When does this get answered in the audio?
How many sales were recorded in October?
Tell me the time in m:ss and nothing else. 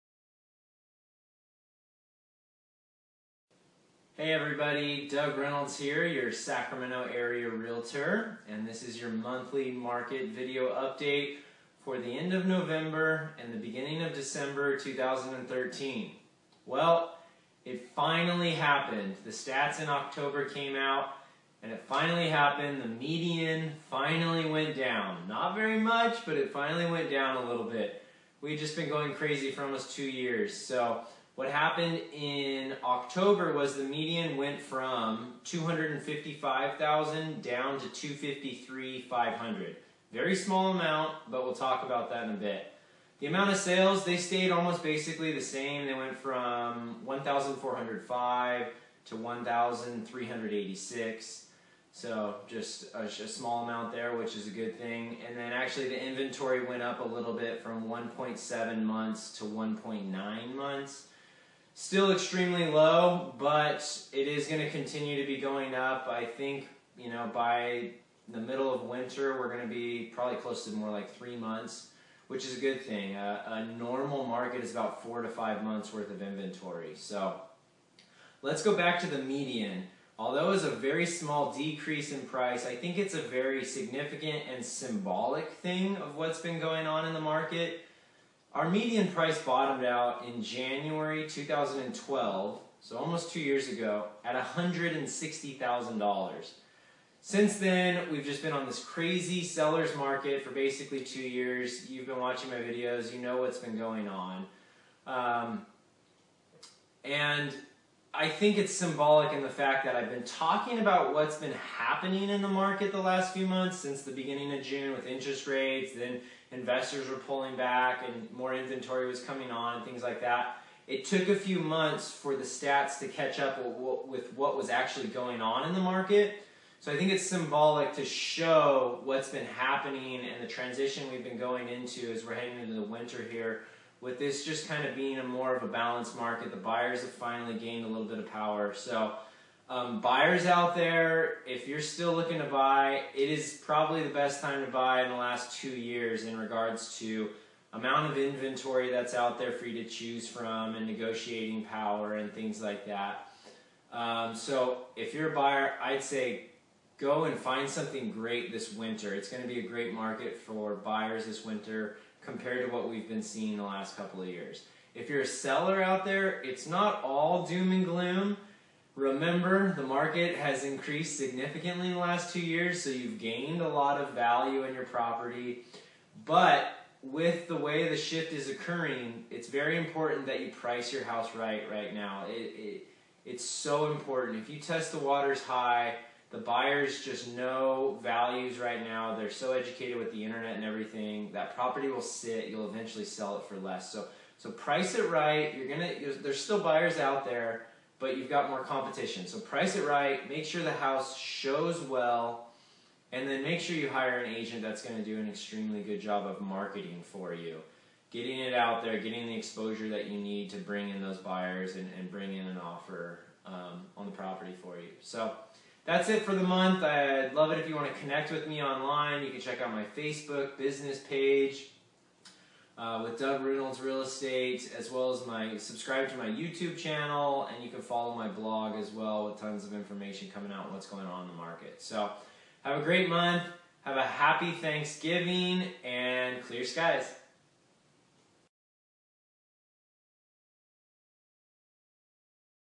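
0:49.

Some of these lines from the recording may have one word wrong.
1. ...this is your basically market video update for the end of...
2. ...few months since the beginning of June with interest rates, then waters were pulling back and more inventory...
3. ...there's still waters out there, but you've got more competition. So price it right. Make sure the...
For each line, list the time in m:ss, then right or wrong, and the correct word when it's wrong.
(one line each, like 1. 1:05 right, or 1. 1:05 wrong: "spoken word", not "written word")
1. 0:08 wrong: "monthly", not "basically"
2. 1:53 wrong: "investors", not "waters"
3. 3:16 wrong: "buyers", not "waters".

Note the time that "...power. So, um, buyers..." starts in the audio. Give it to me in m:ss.
2:18.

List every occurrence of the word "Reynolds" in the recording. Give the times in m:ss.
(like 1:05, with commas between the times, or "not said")
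0:05, 3:43.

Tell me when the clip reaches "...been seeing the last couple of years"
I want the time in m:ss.
2:43.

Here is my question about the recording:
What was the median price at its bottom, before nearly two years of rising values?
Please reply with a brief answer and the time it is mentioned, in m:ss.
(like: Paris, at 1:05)
$160,000, at 1:34.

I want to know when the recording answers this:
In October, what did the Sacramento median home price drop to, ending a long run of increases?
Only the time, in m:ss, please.
0:37.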